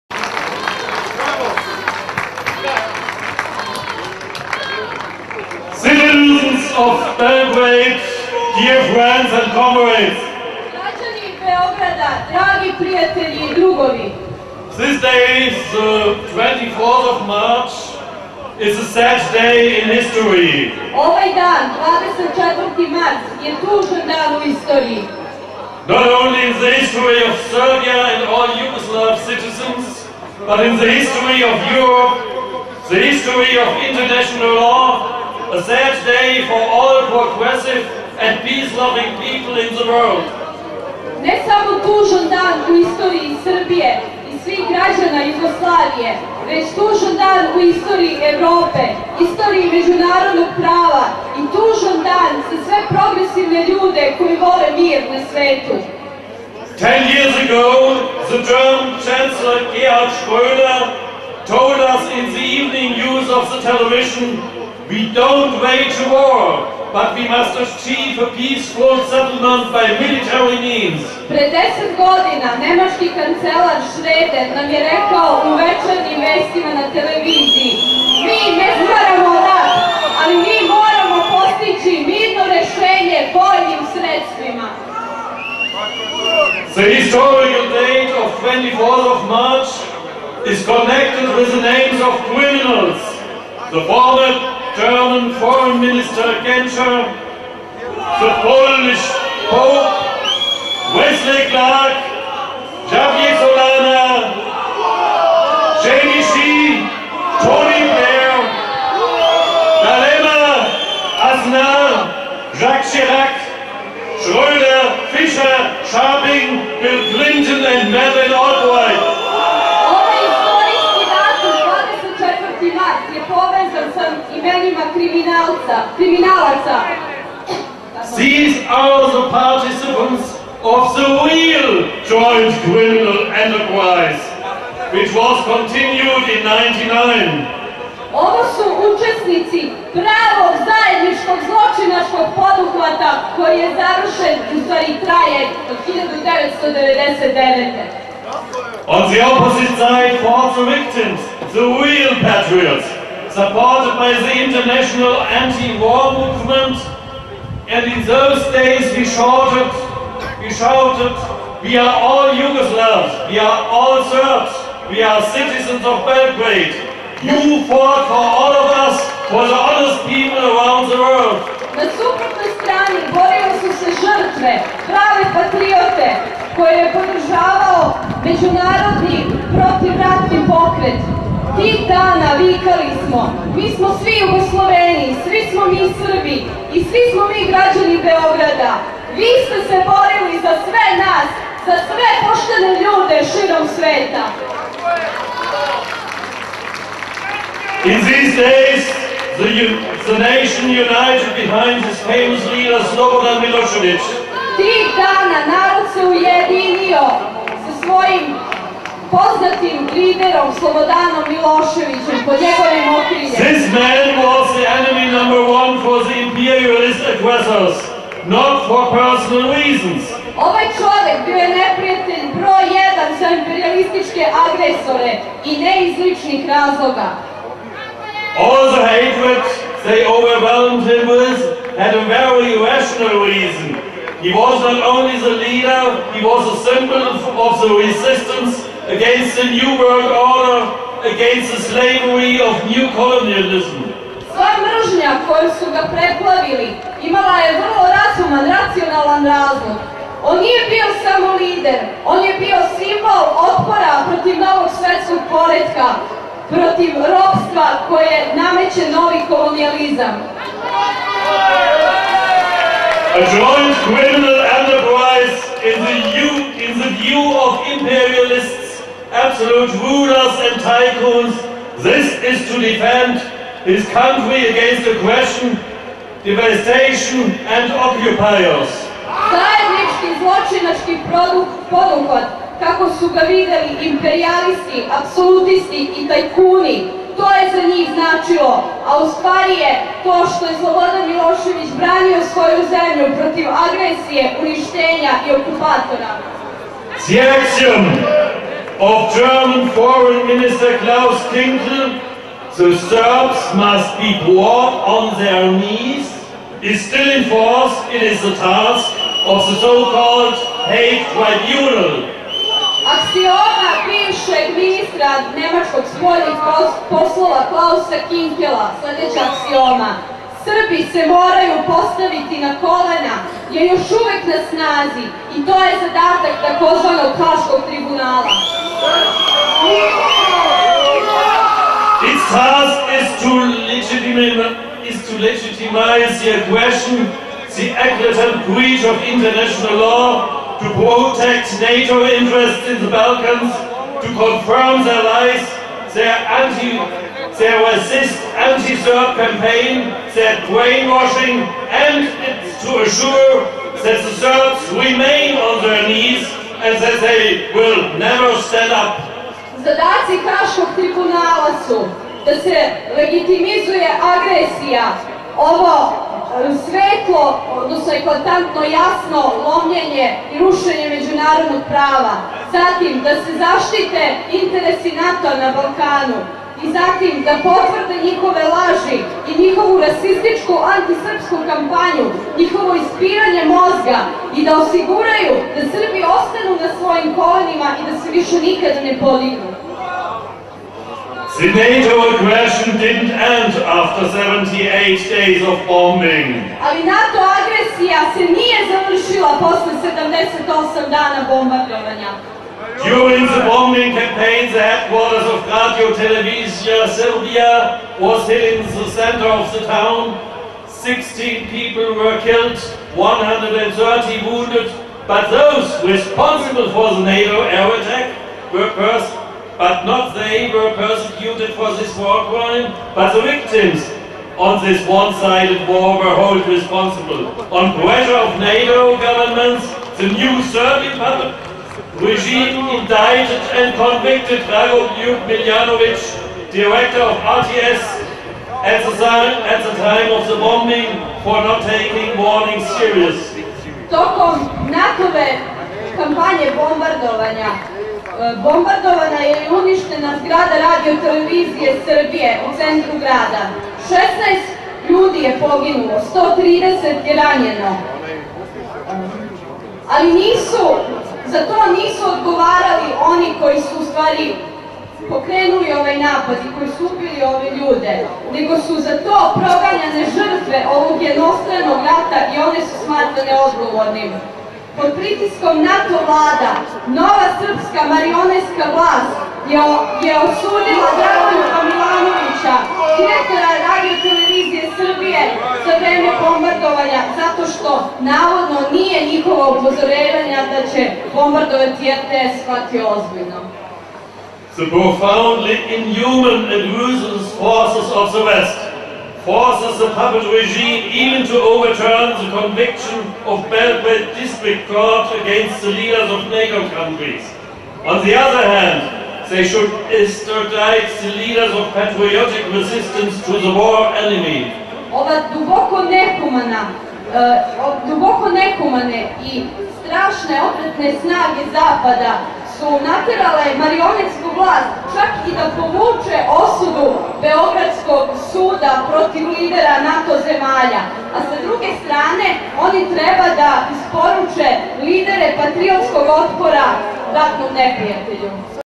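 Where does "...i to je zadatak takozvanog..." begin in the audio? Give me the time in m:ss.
5:25.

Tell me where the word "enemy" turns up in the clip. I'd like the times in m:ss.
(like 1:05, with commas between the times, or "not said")
3:34, 8:34.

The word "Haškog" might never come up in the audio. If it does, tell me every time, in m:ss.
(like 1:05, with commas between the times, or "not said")
5:27, 6:00.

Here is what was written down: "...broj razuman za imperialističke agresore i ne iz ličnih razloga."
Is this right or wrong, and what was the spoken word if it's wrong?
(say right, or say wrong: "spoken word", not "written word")
wrong: "jedan", not "razuman".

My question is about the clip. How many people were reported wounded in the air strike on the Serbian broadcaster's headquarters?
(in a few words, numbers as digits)
130.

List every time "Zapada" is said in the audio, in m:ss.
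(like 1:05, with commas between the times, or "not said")
8:41.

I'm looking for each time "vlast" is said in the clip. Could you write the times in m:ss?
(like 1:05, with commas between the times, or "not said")
7:58, 8:44.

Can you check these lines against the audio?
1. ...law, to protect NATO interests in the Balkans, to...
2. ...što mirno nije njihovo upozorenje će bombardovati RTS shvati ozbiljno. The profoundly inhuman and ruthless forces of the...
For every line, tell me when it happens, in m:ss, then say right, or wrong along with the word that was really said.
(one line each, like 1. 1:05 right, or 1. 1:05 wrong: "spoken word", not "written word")
1. 5:39 right
2. 8:07 wrong: "navodno", not "mirno".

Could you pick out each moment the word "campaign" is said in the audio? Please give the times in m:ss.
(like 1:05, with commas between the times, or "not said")
5:49, 6:43.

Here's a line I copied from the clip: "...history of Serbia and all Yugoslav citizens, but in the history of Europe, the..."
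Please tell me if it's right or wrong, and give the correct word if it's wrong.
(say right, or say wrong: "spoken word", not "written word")
right.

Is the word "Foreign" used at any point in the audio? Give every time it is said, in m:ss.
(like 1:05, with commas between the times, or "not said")
1:35, 4:59.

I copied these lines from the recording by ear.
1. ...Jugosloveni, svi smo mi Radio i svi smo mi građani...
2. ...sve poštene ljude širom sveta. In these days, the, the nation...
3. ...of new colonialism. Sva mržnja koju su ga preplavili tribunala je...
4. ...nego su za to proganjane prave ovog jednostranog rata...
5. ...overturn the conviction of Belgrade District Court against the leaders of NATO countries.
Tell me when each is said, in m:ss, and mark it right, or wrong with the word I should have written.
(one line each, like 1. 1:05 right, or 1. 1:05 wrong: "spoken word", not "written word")
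1. 3:04 wrong: "Srbi", not "Radio"
2. 3:11 right
3. 4:02 wrong: "imala", not "tribunala"
4. 7:48 wrong: "žrtve", not "prave"
5. 8:21 right.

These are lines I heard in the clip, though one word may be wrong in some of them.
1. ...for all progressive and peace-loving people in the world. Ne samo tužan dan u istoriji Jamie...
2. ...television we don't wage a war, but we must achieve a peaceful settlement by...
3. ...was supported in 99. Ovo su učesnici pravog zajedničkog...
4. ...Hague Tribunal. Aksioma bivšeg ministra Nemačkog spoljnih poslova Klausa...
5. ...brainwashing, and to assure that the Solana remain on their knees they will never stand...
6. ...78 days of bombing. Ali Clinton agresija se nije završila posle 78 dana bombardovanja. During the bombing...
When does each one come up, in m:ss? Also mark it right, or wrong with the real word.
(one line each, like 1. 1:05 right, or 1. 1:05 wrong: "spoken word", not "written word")
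1. 0:36 wrong: "Srbije", not "Jamie"
2. 1:03 right
3. 2:15 wrong: "continued", not "supported"
4. 5:10 right
5. 5:50 wrong: "Serbs", not "Solana"
6. 6:34 wrong: "NATO", not "Clinton".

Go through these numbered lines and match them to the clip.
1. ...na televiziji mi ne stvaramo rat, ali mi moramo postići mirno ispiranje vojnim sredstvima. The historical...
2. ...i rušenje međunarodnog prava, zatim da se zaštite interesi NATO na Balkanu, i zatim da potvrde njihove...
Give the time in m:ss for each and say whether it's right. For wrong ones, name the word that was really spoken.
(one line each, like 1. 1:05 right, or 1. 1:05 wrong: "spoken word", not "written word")
1. 1:16 wrong: "rešenje", not "ispiranje"
2. 6:10 right.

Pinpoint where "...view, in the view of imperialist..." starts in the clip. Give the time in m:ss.
4:26.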